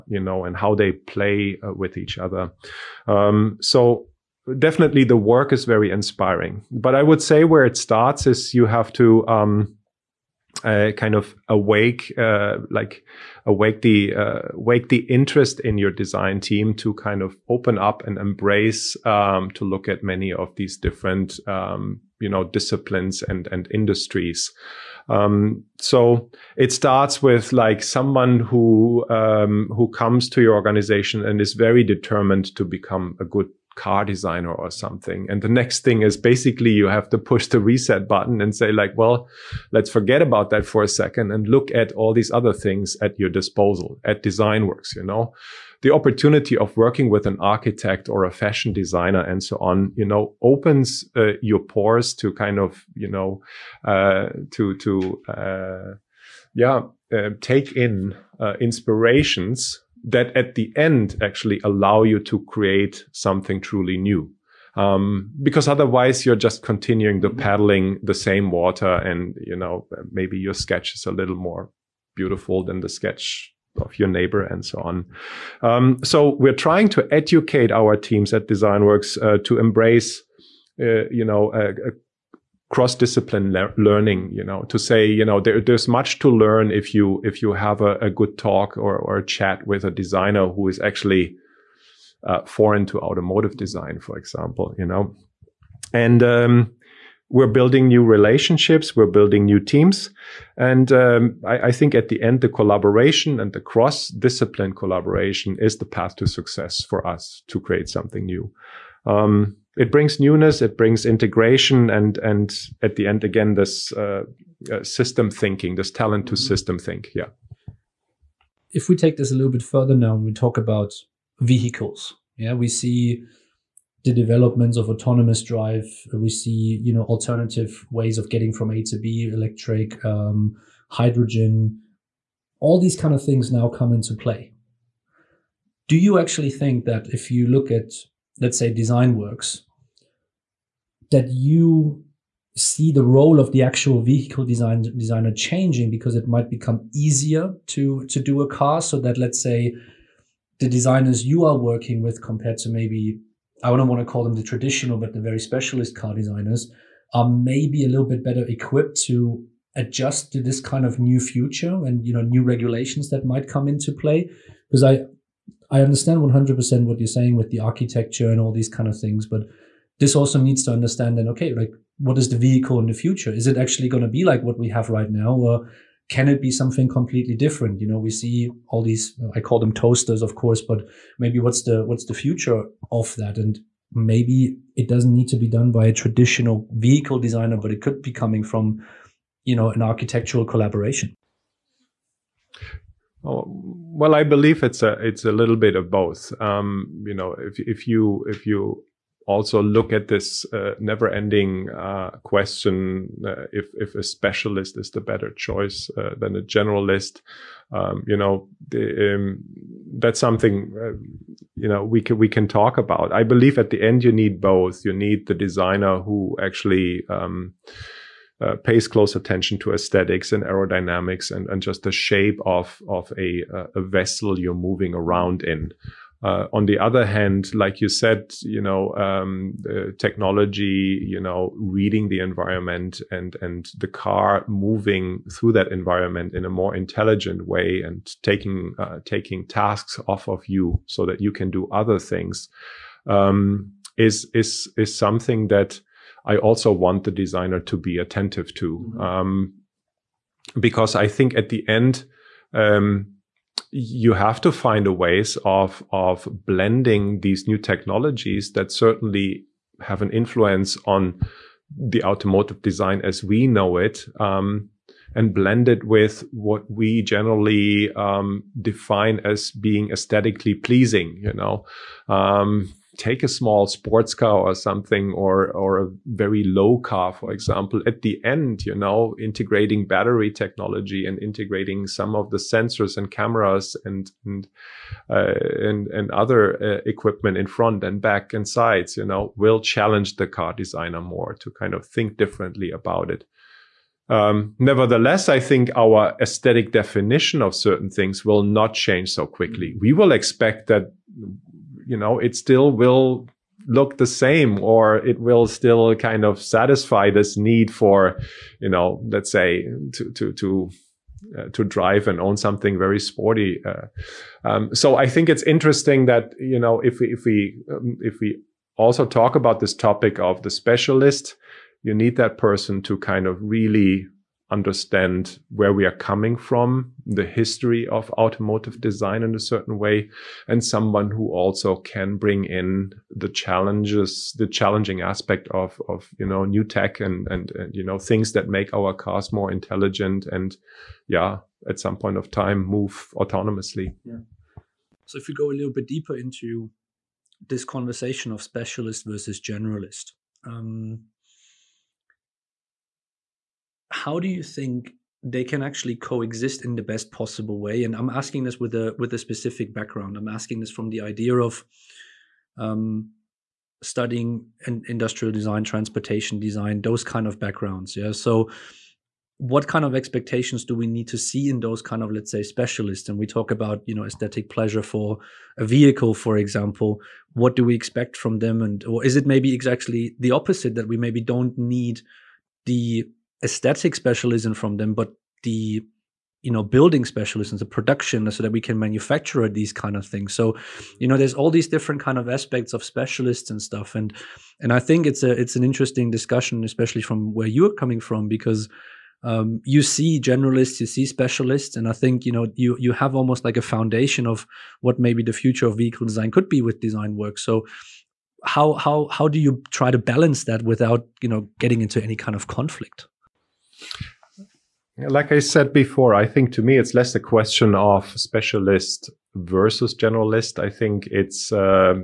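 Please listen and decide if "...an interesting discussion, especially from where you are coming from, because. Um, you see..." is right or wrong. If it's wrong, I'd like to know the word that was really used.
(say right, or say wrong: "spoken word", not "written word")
right.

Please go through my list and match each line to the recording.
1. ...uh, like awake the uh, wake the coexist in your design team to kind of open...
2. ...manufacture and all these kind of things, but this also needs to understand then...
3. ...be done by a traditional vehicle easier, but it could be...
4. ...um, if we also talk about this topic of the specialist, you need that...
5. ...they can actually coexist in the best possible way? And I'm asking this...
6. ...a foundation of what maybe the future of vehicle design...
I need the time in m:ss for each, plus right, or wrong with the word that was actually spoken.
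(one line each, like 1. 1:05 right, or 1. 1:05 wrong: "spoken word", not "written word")
1. 0:12 wrong: "interest", not "coexist"
2. 2:47 wrong: "architecture", not "manufacture"
3. 3:05 wrong: "designer", not "easier"
4. 5:17 right
5. 5:55 right
6. 6:43 right.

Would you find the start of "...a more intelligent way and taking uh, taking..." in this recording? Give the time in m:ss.
3:56.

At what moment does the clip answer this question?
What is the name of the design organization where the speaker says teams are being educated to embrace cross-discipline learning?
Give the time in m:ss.
1:18.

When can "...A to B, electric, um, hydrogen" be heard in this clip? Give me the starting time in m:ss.
2:08.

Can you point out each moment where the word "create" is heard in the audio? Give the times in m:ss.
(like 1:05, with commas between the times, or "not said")
1:02, 1:47.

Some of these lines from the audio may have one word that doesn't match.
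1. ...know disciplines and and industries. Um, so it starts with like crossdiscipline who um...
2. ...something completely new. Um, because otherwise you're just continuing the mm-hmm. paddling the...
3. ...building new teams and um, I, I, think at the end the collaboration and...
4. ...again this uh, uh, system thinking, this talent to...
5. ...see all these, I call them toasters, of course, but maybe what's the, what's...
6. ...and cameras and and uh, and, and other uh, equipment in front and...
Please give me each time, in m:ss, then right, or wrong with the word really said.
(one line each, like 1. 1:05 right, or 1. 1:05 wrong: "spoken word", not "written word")
1. 0:22 wrong: "someone", not "crossdiscipline"
2. 1:03 wrong: "truly", not "completely"
3. 1:39 right
4. 1:53 right
5. 2:58 right
6. 4:42 right.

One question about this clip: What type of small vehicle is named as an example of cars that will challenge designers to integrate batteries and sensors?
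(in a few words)
sports car.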